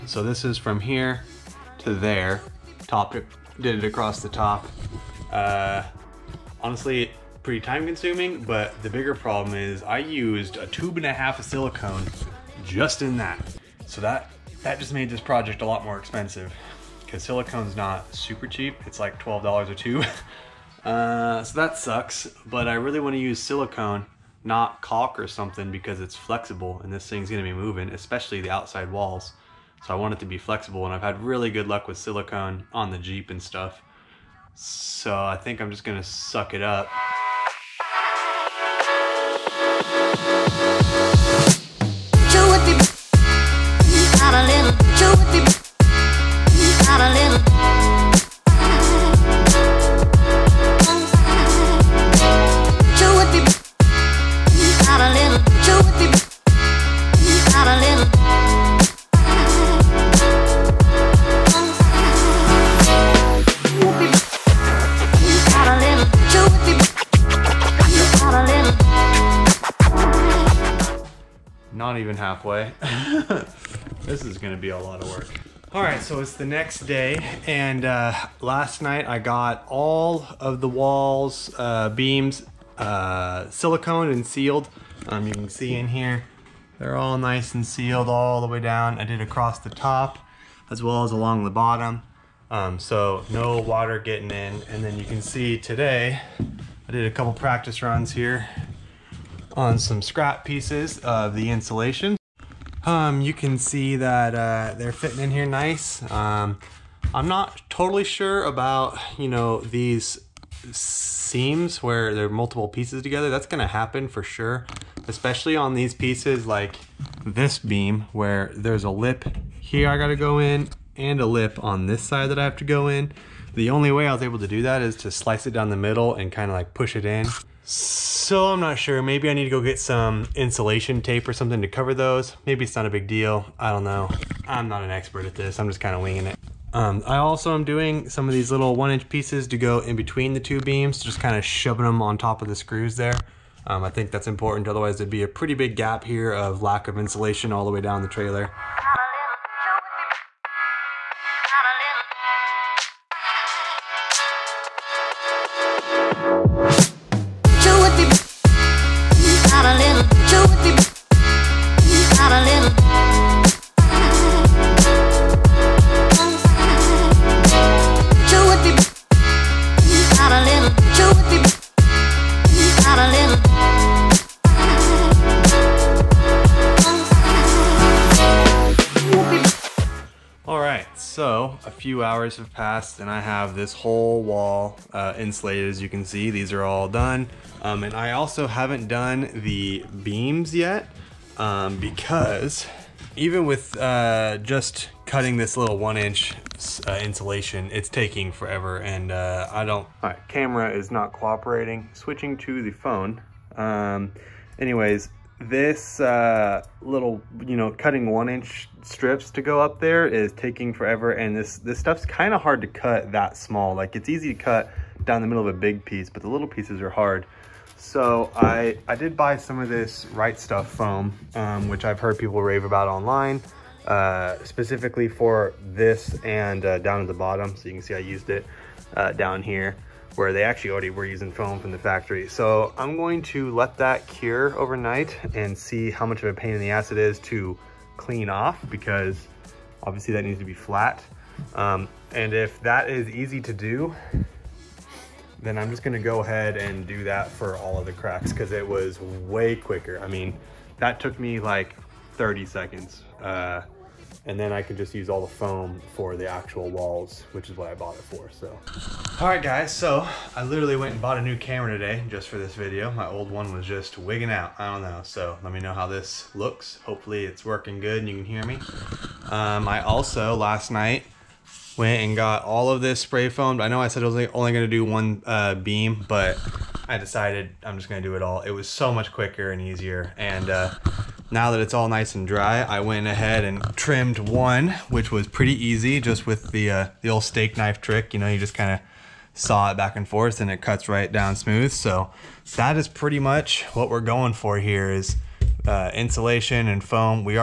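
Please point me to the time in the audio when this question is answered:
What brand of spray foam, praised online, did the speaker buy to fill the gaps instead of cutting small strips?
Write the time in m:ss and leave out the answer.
3:40.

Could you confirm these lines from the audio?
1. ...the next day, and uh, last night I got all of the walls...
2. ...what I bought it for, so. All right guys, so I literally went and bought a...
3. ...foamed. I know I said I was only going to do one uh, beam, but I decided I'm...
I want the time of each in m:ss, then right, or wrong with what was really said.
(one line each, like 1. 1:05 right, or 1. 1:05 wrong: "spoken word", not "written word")
1. 1:16 right
2. 4:17 right
3. 4:33 right.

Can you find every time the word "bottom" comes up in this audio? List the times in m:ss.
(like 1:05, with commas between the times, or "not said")
1:31, 3:47.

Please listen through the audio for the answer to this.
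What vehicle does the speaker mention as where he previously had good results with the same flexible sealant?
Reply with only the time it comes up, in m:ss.
0:32.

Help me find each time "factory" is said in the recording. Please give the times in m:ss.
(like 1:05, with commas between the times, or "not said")
3:51.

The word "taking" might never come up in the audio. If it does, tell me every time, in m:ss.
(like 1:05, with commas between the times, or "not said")
3:17, 3:30.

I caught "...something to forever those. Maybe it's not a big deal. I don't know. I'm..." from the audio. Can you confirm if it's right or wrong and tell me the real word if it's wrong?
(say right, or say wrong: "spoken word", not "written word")
wrong: "cover", not "forever".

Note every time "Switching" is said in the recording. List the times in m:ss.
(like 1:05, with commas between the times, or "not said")
3:21.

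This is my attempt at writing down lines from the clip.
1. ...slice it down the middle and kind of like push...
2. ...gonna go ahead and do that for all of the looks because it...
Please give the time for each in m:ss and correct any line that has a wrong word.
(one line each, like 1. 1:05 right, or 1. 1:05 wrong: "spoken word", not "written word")
1. 2:05 right
2. 4:05 wrong: "cracks", not "looks".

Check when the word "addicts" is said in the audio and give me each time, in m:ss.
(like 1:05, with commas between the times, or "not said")
not said.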